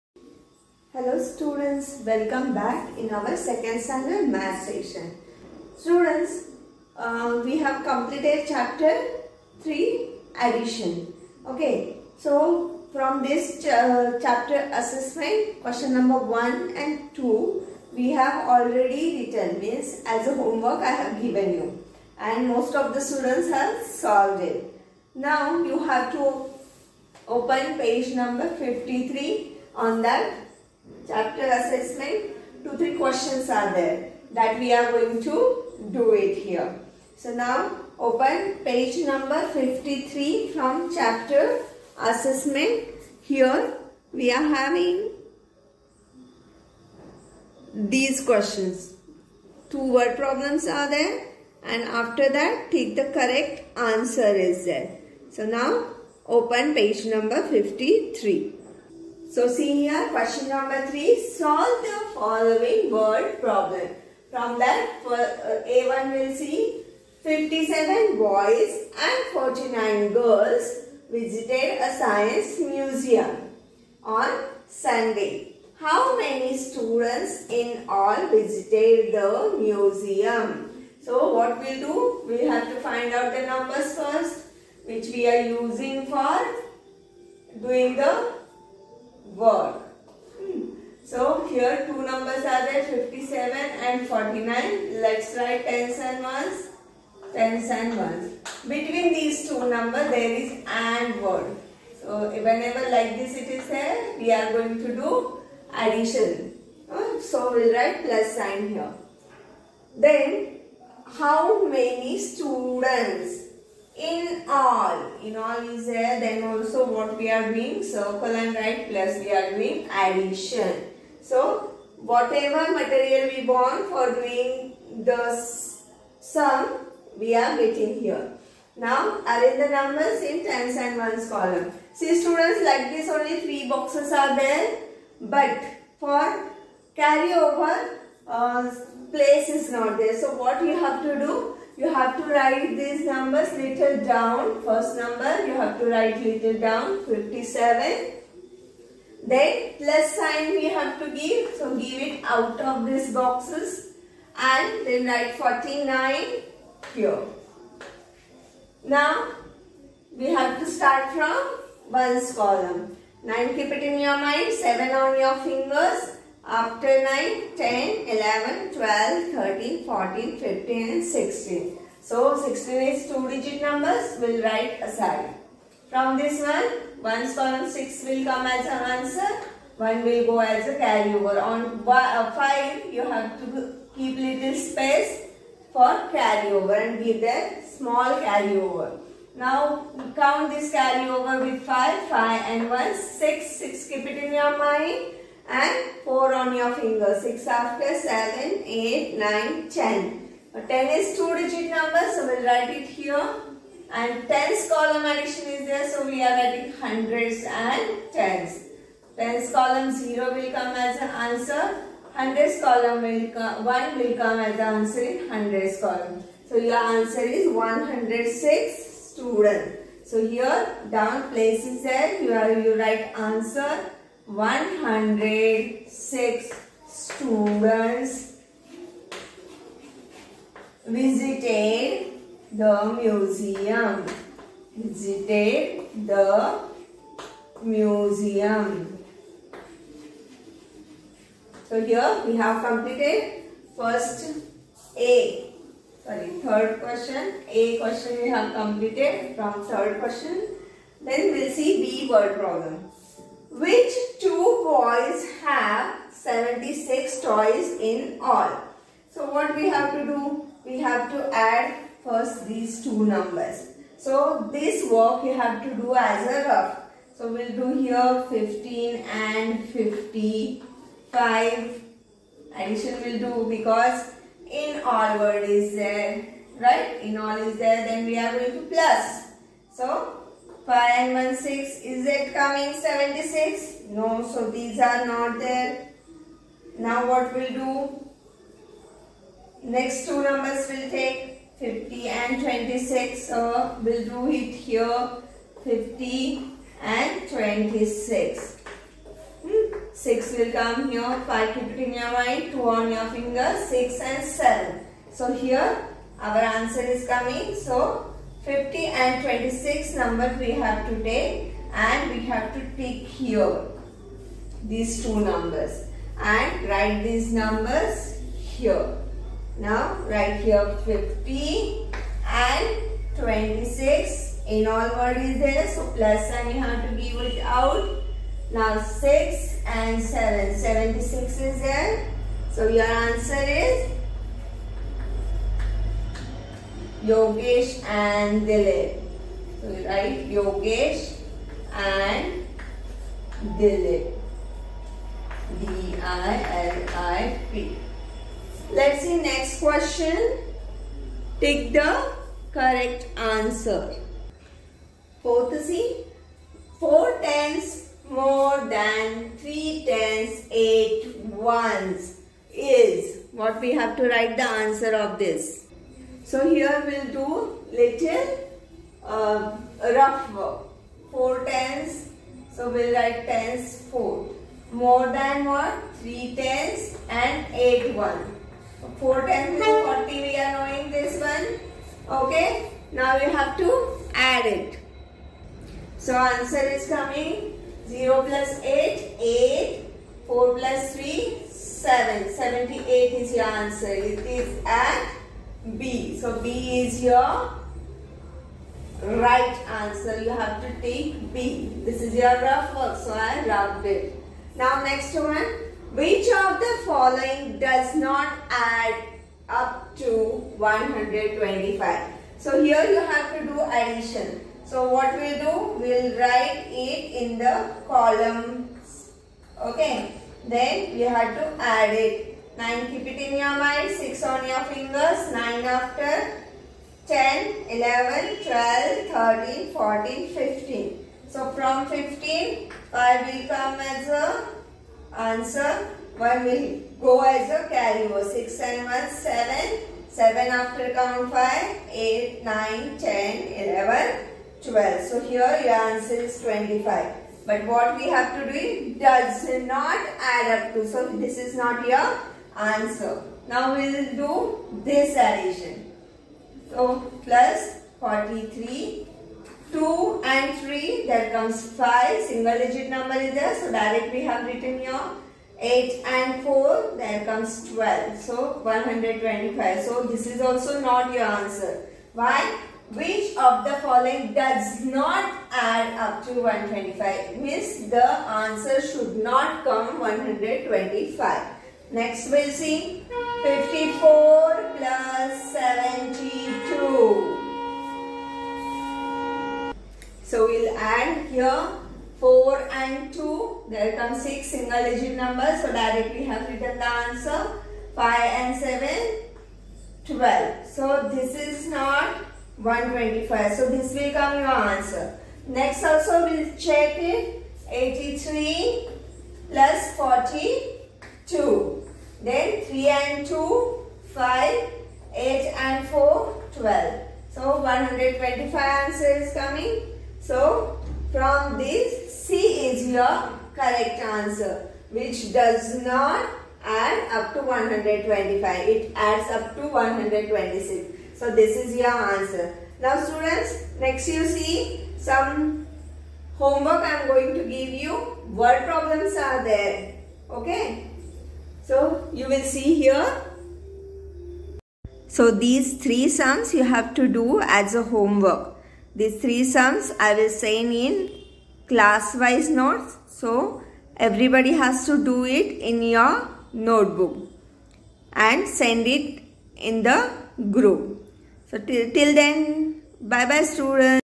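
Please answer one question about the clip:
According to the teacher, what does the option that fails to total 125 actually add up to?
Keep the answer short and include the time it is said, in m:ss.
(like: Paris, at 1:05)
126, at 8:48.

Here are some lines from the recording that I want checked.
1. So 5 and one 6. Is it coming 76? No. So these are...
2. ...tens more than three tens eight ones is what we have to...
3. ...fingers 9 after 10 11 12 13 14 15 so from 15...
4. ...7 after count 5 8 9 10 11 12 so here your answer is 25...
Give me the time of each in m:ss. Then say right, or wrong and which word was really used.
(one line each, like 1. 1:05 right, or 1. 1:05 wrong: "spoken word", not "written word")
1. 4:39 right
2. 5:57 right
3. 7:04 right
4. 7:20 right.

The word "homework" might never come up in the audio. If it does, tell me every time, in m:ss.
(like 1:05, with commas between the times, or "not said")
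0:20, 8:56, 9:07.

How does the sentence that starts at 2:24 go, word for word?
First number you have to write little down 57.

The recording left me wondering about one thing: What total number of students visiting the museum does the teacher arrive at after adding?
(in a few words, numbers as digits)
106.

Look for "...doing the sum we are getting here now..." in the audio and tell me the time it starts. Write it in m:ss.
2:04.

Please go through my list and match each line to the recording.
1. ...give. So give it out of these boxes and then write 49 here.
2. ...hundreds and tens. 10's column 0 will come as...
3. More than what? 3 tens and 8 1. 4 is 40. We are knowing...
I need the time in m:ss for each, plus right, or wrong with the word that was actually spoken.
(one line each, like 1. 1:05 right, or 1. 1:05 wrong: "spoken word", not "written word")
1. 2:31 right
2. 3:26 right
3. 6:14 right.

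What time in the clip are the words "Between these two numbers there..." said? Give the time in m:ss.
1:38.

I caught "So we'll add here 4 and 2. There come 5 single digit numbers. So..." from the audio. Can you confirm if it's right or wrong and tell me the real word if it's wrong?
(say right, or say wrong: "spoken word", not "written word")
wrong: "6", not "5".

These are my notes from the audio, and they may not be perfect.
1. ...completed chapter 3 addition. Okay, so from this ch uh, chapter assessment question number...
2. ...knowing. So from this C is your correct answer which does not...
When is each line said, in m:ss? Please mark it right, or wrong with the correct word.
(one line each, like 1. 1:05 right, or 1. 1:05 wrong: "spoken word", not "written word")
1. 0:07 right
2. 8:39 wrong: "coming", not "knowing".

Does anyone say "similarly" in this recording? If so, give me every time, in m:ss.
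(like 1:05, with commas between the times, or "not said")
not said.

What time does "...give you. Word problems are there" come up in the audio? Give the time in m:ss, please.
8:57.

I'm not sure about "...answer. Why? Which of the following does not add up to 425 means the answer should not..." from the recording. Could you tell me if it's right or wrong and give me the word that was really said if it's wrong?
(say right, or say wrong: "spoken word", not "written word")
wrong: "125", not "425".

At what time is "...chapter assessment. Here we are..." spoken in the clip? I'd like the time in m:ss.
0:40.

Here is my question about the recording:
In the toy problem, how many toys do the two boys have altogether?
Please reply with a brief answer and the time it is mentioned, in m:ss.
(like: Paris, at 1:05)
76, at 4:16.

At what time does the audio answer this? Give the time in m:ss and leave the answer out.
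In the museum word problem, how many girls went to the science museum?
1:09.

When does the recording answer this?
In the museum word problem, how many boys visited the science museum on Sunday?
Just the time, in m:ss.
1:07.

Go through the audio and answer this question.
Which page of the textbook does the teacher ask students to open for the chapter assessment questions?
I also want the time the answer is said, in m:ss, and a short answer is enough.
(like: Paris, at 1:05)
53, at 0:27.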